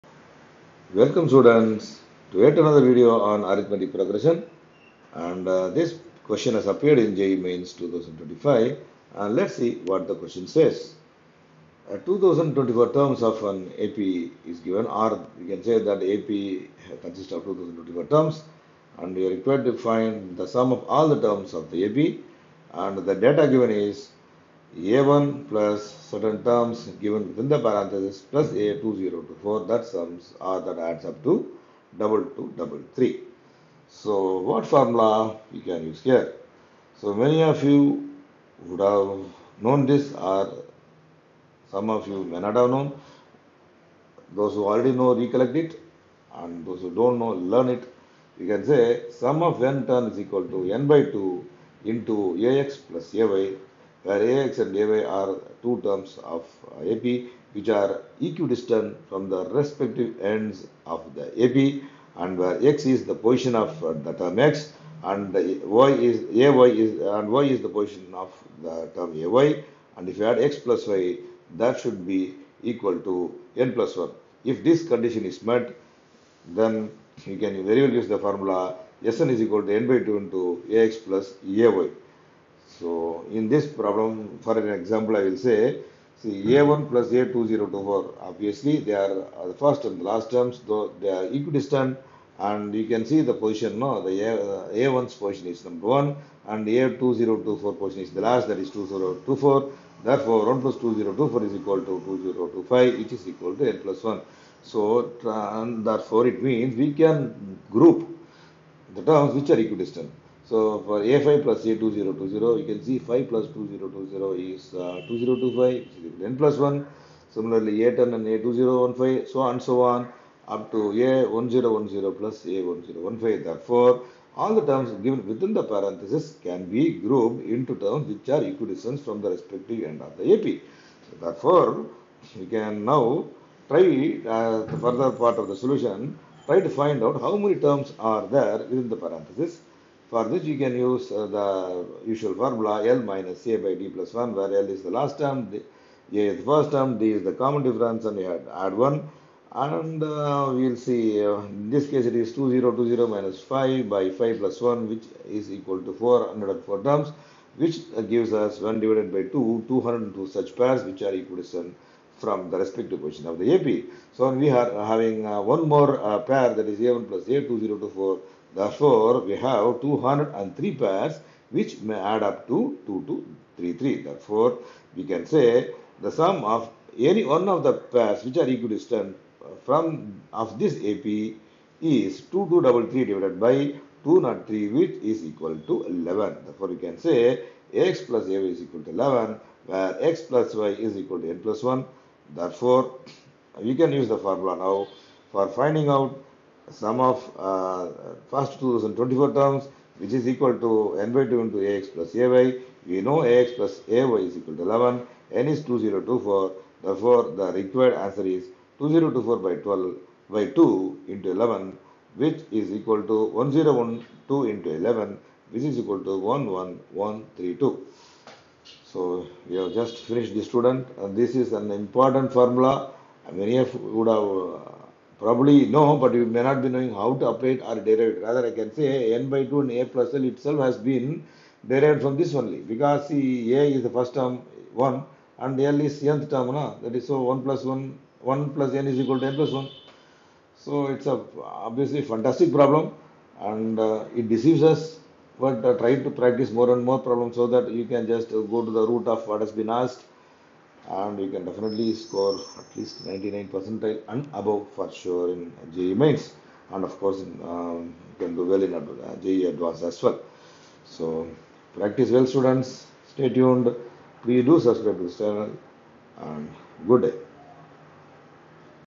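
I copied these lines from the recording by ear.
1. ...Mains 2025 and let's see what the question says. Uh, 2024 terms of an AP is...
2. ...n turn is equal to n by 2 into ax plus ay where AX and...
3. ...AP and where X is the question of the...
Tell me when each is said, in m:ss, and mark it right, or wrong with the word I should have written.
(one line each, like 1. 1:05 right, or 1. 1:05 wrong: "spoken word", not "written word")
1. 0:07 right
2. 0:49 right
3. 1:01 wrong: "position", not "question".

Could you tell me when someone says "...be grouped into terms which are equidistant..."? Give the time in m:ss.
2:06.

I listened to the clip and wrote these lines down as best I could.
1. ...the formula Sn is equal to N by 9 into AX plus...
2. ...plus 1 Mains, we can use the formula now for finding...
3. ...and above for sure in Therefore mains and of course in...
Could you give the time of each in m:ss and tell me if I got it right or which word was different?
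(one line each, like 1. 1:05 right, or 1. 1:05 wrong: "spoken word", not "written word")
1. 1:18 wrong: "2", not "9"
2. 3:11 wrong: "Therefore", not "Mains"
3. 4:14 wrong: "JEE", not "Therefore".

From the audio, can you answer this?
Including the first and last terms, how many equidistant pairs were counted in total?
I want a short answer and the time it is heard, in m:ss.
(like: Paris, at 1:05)
203, at 2:49.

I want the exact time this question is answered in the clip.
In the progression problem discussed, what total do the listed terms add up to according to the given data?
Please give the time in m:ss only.
0:31.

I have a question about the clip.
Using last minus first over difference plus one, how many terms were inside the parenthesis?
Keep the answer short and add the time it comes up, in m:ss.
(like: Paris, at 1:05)
404, at 2:35.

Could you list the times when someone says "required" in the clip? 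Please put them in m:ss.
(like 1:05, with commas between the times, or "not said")
0:19, 3:27.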